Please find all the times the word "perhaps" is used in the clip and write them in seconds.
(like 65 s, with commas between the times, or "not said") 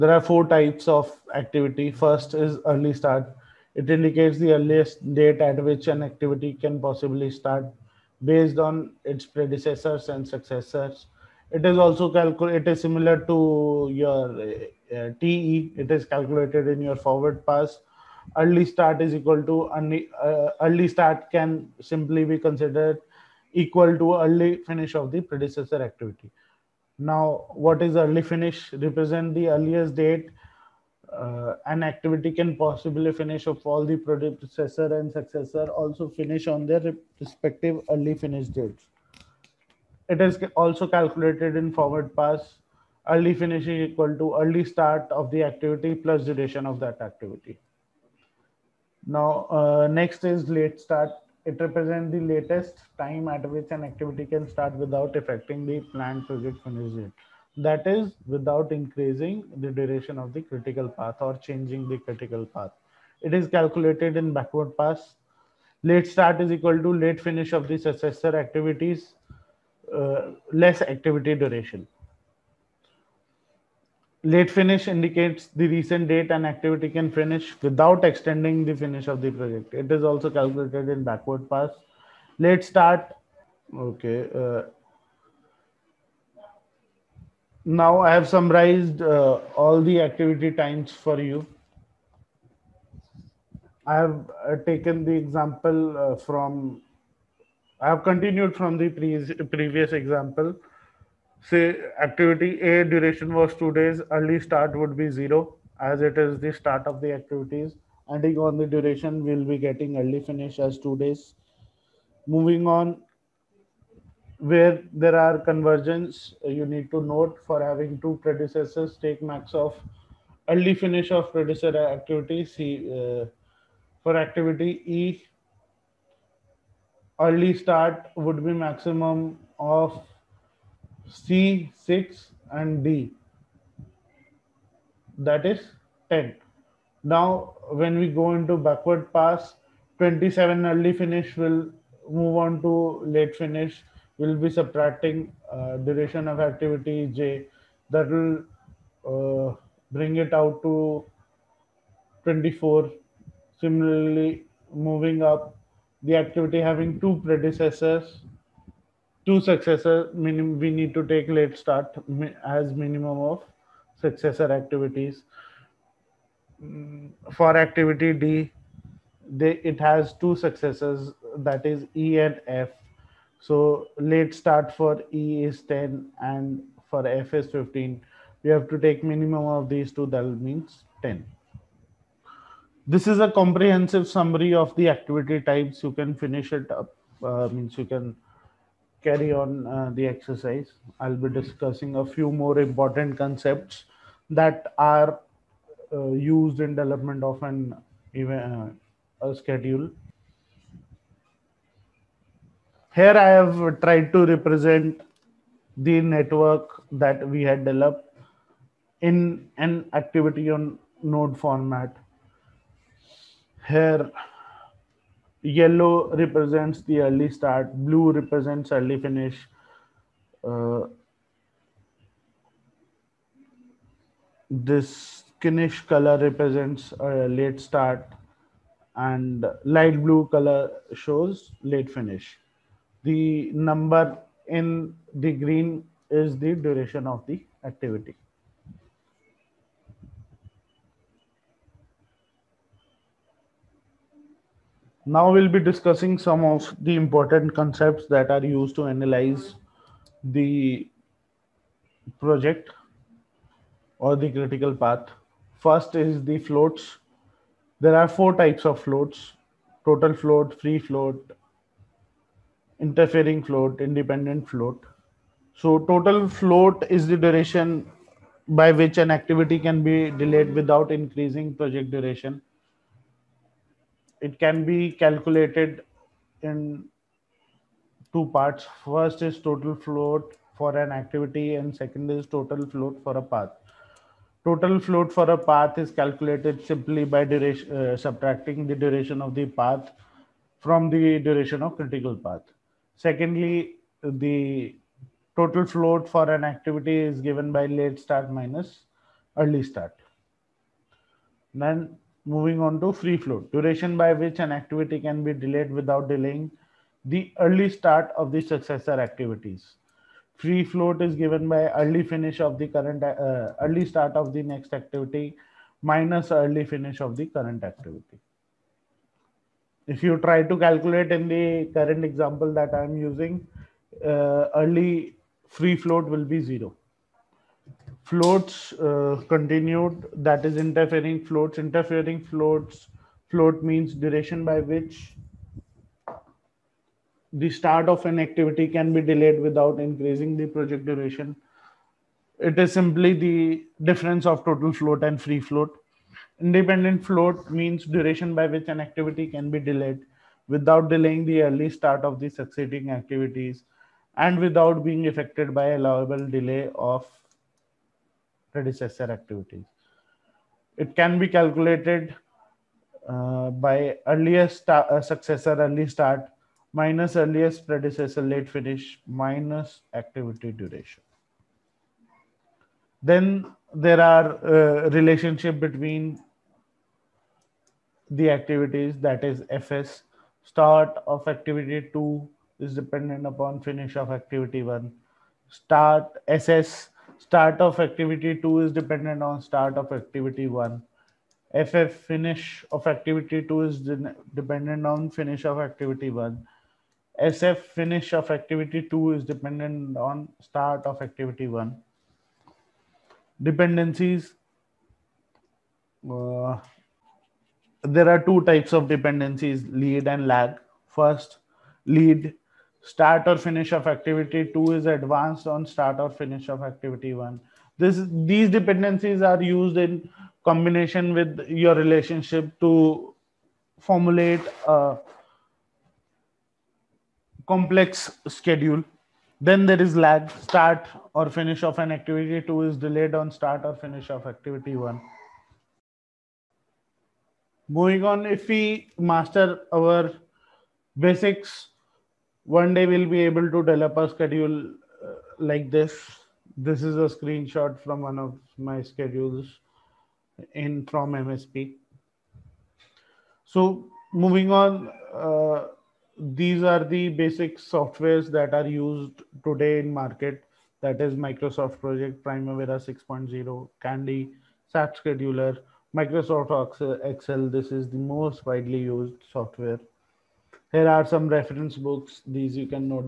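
not said.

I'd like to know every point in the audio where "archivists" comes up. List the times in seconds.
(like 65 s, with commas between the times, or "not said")
not said.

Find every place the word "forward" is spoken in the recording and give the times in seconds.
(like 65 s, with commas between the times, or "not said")
16 s, 41 s.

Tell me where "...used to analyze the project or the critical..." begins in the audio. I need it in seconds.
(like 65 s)
248 s.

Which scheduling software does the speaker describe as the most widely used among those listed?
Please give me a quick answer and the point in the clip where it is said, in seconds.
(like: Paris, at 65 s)
Microsoft Excel, at 465 s.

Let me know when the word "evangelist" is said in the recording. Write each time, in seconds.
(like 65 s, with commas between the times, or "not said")
not said.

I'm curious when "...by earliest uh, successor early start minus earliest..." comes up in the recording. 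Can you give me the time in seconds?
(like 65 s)
363 s.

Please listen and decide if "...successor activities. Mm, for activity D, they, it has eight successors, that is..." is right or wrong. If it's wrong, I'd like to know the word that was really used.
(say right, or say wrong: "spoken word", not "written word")
wrong: "two", not "eight".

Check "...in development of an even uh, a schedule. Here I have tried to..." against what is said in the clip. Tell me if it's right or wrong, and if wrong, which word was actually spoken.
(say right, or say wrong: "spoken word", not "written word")
right.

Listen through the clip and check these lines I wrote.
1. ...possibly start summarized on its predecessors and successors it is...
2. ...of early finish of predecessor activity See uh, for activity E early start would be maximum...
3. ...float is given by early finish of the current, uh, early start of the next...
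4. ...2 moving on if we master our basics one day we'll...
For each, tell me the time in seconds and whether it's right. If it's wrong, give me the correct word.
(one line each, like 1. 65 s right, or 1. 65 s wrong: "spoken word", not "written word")
1. 6 s wrong: "based", not "summarized"
2. 119 s right
3. 310 s right
4. 434 s wrong: "1", not "2".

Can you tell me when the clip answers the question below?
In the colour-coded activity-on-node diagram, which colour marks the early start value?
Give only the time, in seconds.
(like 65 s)
215 s.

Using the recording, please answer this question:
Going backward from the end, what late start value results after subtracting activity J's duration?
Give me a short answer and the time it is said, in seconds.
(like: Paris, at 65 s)
24, at 152 s.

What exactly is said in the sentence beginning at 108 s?
Ending on the duration, we'll be getting early finish as two days.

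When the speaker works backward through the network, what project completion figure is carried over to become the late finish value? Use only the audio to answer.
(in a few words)
27.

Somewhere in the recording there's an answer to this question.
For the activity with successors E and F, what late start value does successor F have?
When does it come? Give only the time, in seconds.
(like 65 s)
177 s.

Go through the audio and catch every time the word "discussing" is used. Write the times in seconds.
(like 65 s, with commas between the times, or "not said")
191 s, 245 s.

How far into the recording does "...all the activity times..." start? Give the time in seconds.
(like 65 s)
89 s.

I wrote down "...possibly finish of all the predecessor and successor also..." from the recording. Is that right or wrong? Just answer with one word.
right.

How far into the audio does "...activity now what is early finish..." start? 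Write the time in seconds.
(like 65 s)
25 s.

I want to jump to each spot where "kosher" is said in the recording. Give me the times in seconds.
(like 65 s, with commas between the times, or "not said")
not said.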